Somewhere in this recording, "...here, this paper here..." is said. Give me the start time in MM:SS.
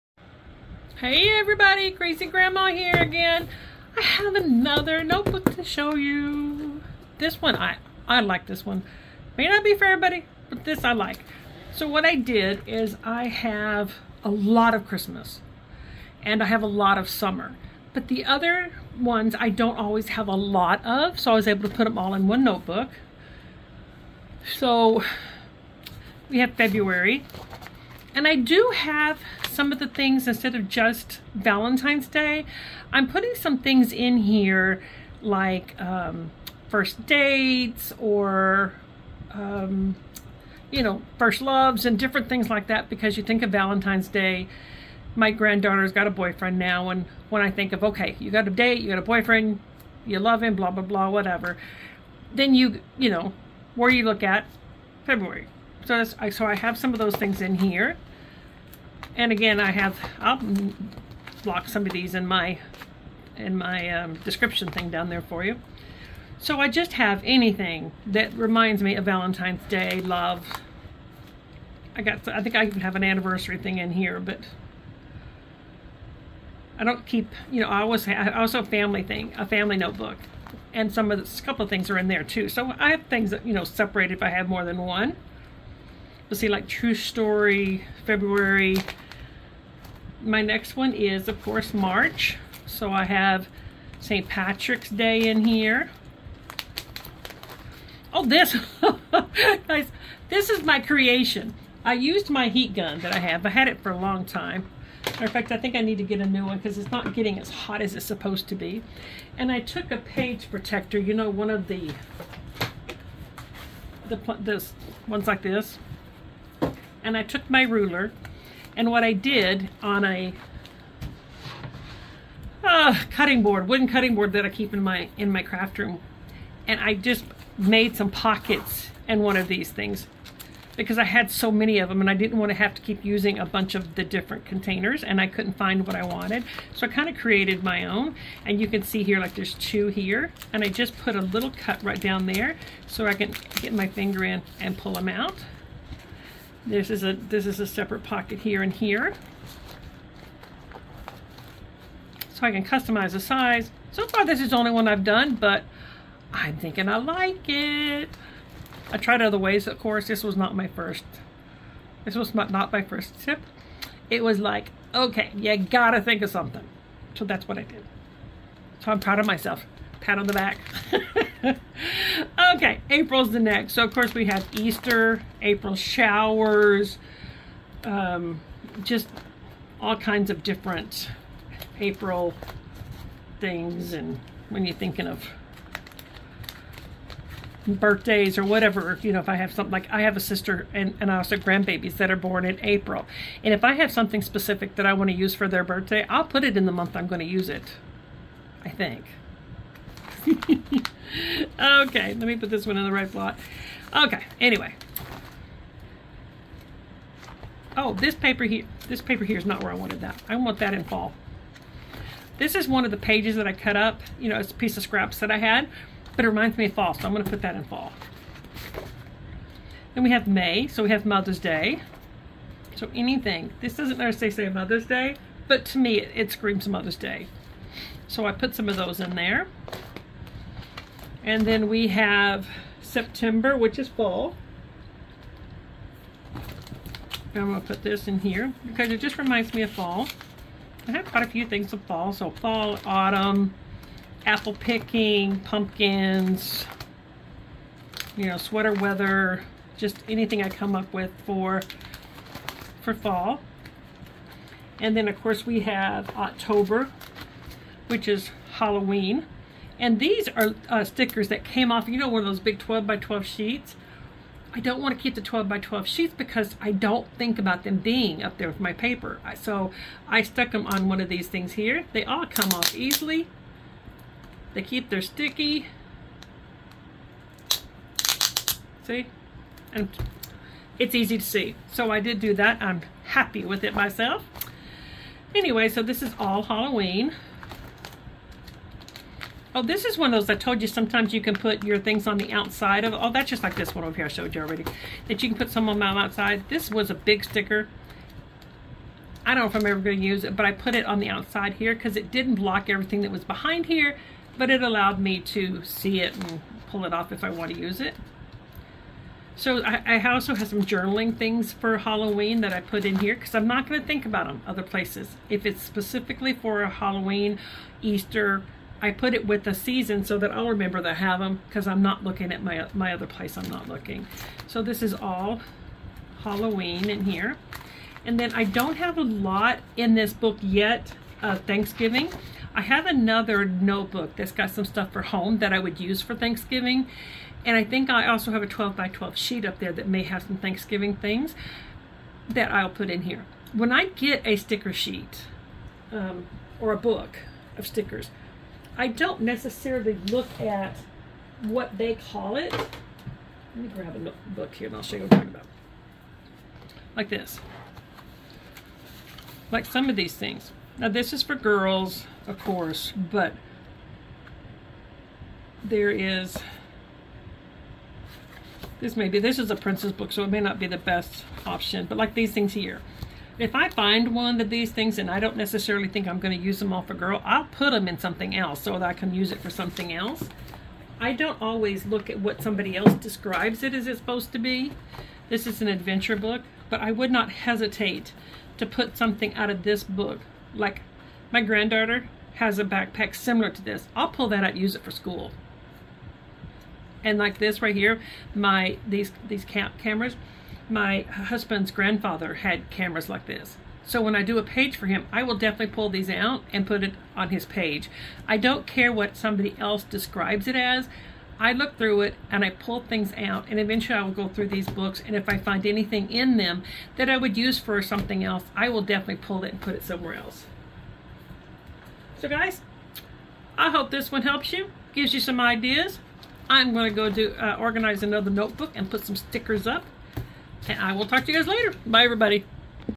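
03:28.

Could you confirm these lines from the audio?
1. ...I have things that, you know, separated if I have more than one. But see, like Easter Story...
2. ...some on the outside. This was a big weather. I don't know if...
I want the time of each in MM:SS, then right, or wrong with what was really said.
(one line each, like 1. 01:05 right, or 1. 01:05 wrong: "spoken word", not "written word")
1. 01:22 wrong: "True", not "Easter"
2. 04:55 wrong: "sticker", not "weather".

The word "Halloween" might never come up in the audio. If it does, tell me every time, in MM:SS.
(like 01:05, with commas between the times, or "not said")
04:18, 04:46, 05:11, 05:16, 05:26.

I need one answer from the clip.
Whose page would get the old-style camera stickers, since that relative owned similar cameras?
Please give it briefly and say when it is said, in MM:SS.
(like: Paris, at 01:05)
Husband's grandfather, at 06:41.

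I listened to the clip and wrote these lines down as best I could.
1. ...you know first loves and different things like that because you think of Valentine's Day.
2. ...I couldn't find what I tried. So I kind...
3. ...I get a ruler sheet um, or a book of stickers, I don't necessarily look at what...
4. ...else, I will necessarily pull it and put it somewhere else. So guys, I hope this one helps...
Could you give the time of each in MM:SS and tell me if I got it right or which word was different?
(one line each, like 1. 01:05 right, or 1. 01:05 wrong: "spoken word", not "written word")
1. 00:40 right
2. 02:15 wrong: "wanted", not "tried"
3. 05:43 wrong: "sticker", not "ruler"
4. 06:58 wrong: "definitely", not "necessarily".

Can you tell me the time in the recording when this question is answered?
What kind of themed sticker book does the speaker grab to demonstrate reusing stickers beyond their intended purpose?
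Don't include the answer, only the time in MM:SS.
06:09.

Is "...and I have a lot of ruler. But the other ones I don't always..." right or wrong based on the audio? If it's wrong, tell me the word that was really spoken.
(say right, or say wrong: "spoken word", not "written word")
wrong: "summer", not "ruler".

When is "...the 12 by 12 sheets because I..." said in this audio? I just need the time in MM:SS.
04:25.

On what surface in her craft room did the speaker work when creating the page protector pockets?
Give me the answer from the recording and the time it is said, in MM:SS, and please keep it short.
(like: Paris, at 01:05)
Wooden cutting board, at 02:03.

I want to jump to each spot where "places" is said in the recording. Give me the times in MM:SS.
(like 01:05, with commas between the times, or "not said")
05:14, 05:23.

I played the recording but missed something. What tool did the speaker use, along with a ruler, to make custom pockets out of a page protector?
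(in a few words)
Heat gun.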